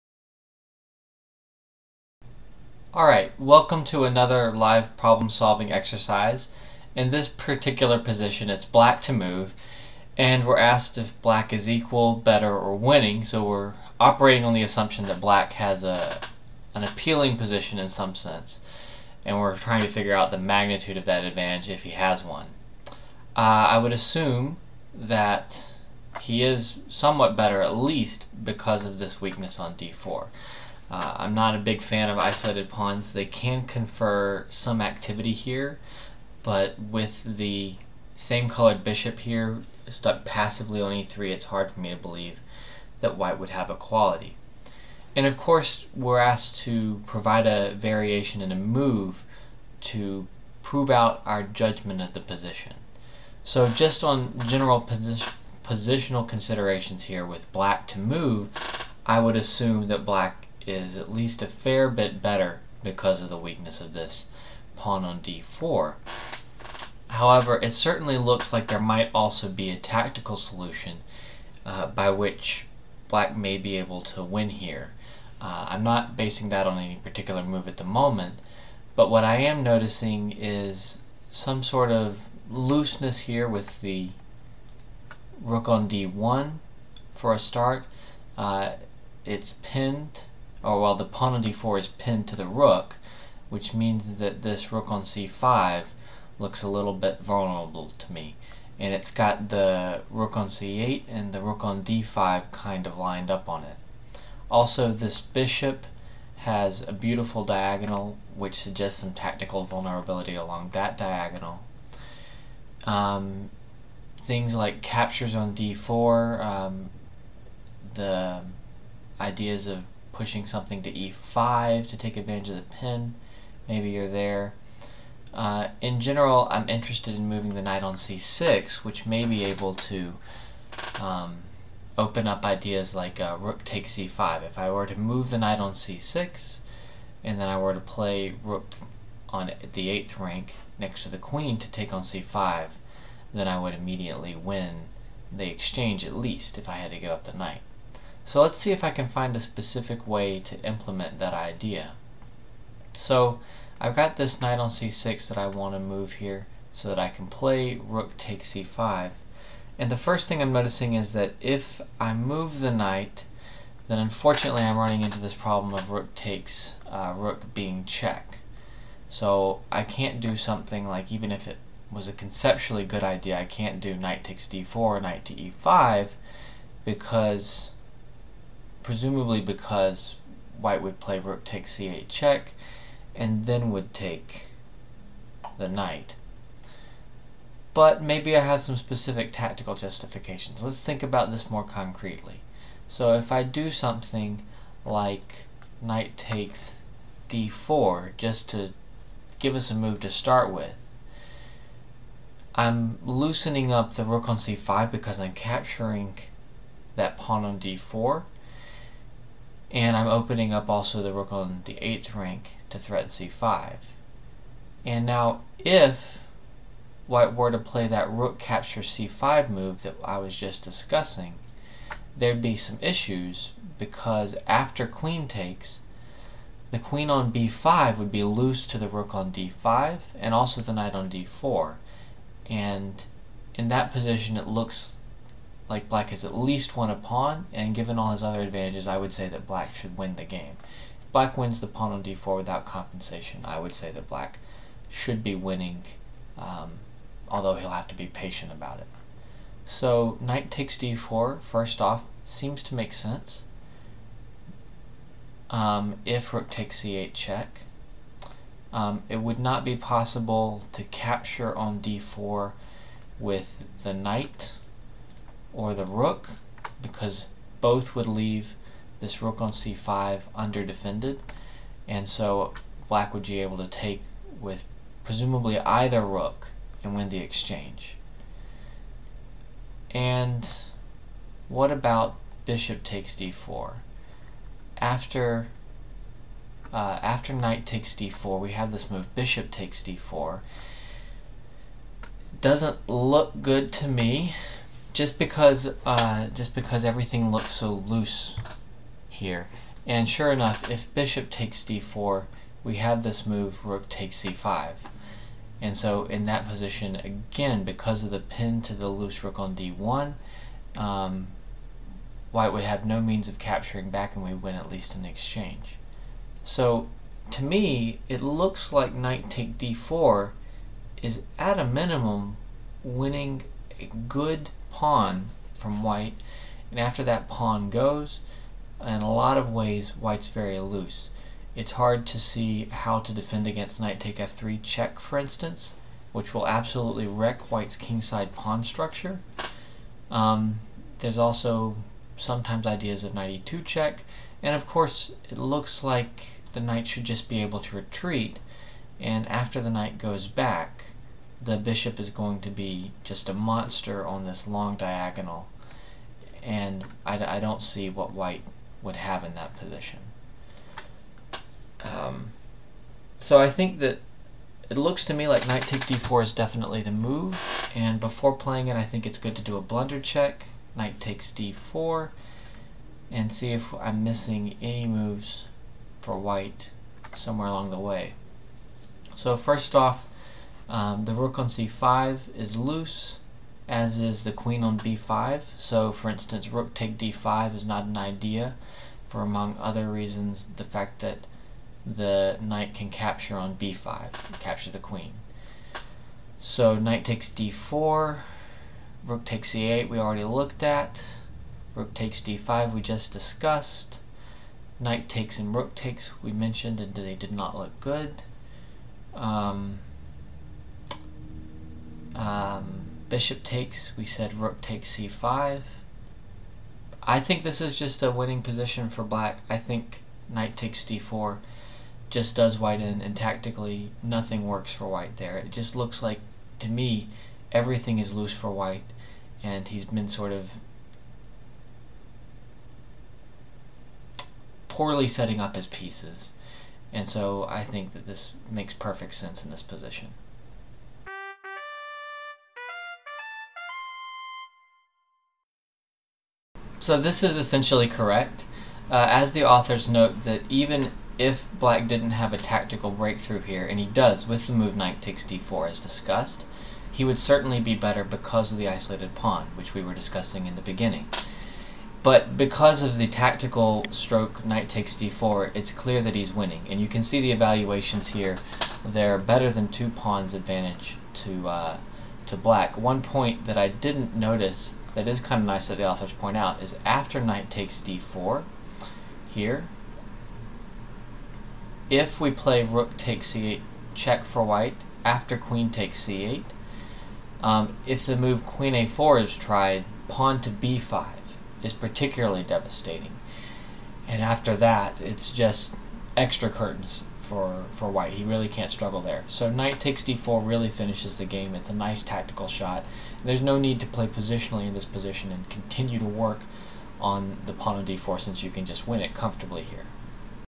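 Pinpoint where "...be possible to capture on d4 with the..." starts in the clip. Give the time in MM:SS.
04:19.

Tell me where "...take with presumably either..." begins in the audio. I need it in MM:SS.
04:33.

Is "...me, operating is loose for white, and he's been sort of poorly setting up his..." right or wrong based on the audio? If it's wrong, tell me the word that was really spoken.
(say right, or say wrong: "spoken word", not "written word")
wrong: "everything", not "operating".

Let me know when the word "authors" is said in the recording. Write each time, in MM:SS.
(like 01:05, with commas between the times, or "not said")
07:29, 07:55.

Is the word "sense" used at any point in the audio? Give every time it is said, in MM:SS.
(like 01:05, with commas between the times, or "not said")
00:18, 04:12, 07:19.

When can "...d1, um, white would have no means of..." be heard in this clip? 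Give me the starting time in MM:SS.
05:09.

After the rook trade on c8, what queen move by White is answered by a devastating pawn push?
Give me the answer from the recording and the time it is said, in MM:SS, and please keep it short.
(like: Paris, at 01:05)
queen a4, at 08:08.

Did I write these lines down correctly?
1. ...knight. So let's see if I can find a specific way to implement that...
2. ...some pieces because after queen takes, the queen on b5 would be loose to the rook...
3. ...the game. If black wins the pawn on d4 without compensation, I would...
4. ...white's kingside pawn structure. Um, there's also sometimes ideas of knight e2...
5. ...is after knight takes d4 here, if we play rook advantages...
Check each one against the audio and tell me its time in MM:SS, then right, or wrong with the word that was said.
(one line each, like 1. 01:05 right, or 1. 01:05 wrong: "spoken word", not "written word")
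1. 02:27 right
2. 03:42 wrong: "issues", not "pieces"
3. 04:00 right
4. 05:37 right
5. 07:56 wrong: "takes", not "advantages".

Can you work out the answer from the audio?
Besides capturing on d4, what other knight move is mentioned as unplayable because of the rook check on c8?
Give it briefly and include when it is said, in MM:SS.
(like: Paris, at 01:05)
knight to e5, at 02:55.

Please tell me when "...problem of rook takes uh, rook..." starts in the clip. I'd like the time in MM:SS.
02:45.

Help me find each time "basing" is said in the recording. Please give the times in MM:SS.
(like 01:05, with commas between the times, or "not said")
01:16.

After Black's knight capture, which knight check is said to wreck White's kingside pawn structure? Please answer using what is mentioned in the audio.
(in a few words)
knight take f3 check.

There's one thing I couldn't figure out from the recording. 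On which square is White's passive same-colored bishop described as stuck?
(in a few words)
e3.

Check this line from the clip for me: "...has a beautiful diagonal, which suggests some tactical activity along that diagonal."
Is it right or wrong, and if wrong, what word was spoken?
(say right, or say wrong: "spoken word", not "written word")
wrong: "vulnerability", not "activity".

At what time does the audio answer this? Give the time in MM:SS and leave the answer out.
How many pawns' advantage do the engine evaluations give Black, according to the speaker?
07:49.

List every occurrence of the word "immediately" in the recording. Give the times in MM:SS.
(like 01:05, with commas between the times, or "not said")
02:23.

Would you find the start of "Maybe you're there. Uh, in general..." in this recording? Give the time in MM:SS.
02:03.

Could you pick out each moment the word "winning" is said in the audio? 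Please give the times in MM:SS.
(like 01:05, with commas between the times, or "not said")
00:12, 04:05, 05:22, 06:58, 07:46.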